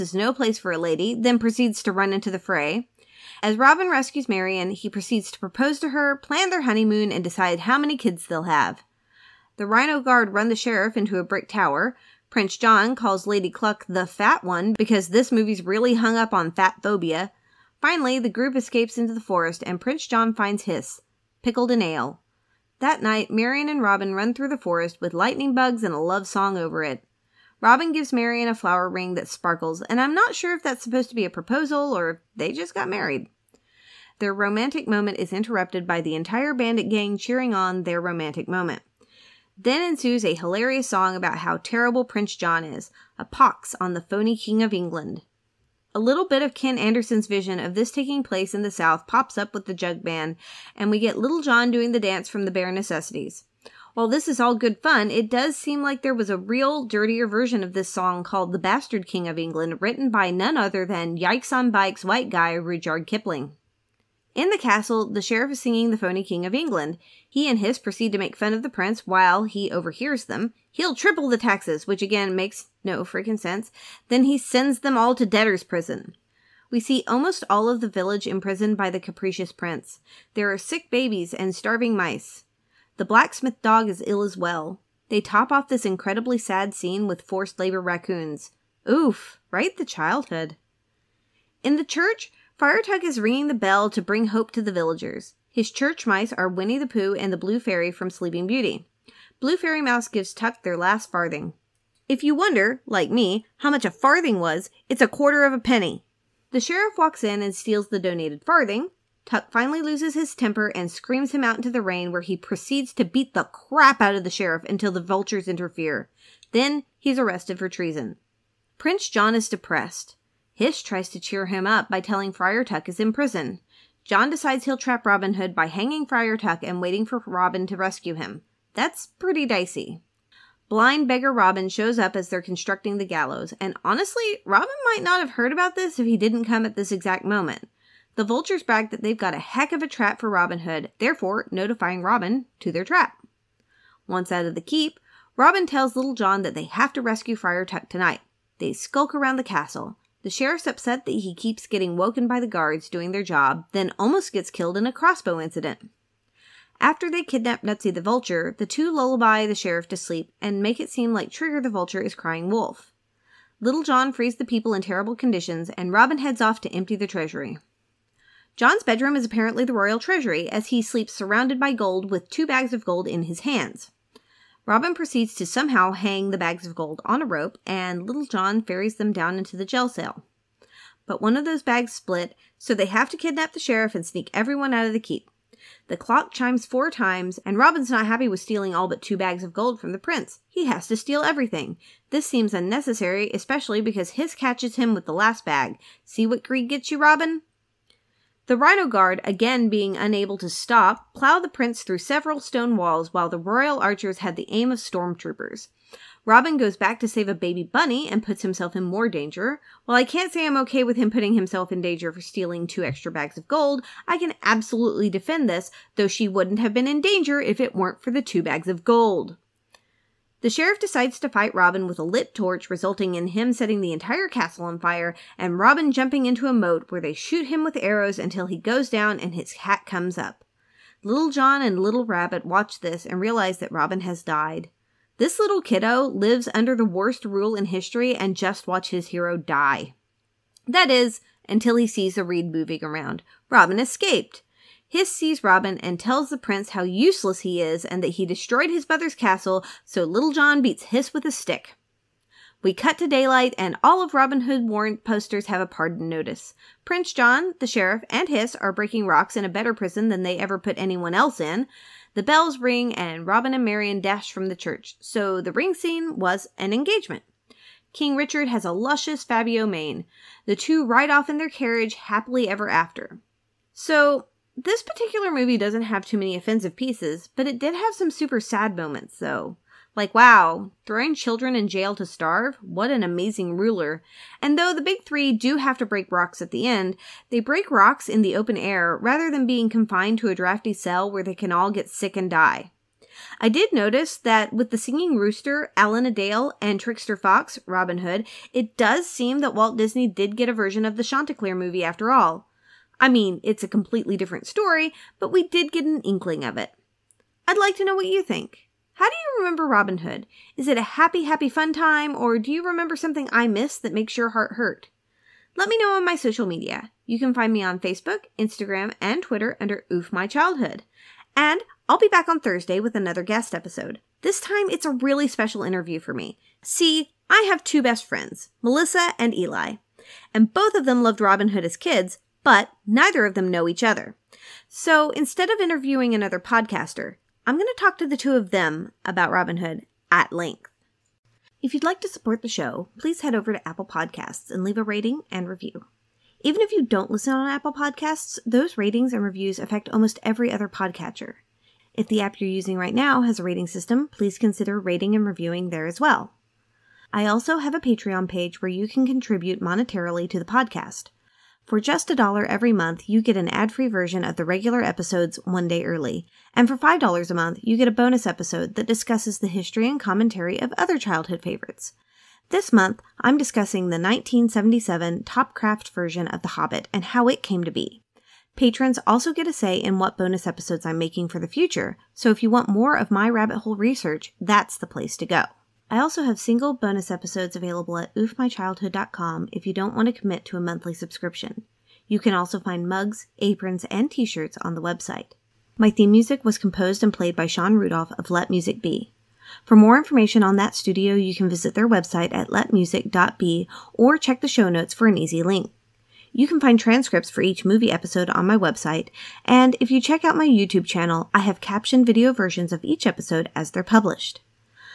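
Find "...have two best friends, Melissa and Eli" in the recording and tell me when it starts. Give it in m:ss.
5:27.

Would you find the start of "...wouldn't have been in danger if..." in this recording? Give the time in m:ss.
3:36.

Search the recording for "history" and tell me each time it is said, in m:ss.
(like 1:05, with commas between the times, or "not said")
3:57, 6:09.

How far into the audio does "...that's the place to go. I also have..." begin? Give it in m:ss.
6:24.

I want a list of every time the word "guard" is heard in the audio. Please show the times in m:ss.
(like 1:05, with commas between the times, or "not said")
0:09, 2:32, 3:18.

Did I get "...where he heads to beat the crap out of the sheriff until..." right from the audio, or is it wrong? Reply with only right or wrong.
wrong.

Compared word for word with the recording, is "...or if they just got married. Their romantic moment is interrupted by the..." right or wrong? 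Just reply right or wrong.
right.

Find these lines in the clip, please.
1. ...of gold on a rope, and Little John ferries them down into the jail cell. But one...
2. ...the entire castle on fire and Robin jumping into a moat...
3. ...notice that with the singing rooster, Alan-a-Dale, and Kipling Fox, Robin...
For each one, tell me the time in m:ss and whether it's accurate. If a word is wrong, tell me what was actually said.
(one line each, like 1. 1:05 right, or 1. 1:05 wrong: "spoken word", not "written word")
1. 2:56 right
2. 3:43 right
3. 4:53 wrong: "Trickster", not "Kipling".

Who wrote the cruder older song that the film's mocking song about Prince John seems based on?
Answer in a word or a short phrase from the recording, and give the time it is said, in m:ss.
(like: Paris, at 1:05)
Rudyard Kipling, at 1:02.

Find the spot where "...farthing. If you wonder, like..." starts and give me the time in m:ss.
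1:41.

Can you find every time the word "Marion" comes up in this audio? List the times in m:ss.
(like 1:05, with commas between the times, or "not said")
0:04, 0:23, 0:28, 4:23.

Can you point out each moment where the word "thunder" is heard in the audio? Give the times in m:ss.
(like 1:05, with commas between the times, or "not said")
not said.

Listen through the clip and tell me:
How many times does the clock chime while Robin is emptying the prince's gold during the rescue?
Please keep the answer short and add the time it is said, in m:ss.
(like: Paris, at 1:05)
4, at 3:06.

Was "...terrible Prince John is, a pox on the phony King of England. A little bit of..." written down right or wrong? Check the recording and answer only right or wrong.
right.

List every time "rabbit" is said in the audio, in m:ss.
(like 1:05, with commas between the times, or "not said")
3:52, 6:23.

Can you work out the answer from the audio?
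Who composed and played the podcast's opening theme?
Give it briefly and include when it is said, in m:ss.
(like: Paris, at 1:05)
Shawn Rudolph, at 6:37.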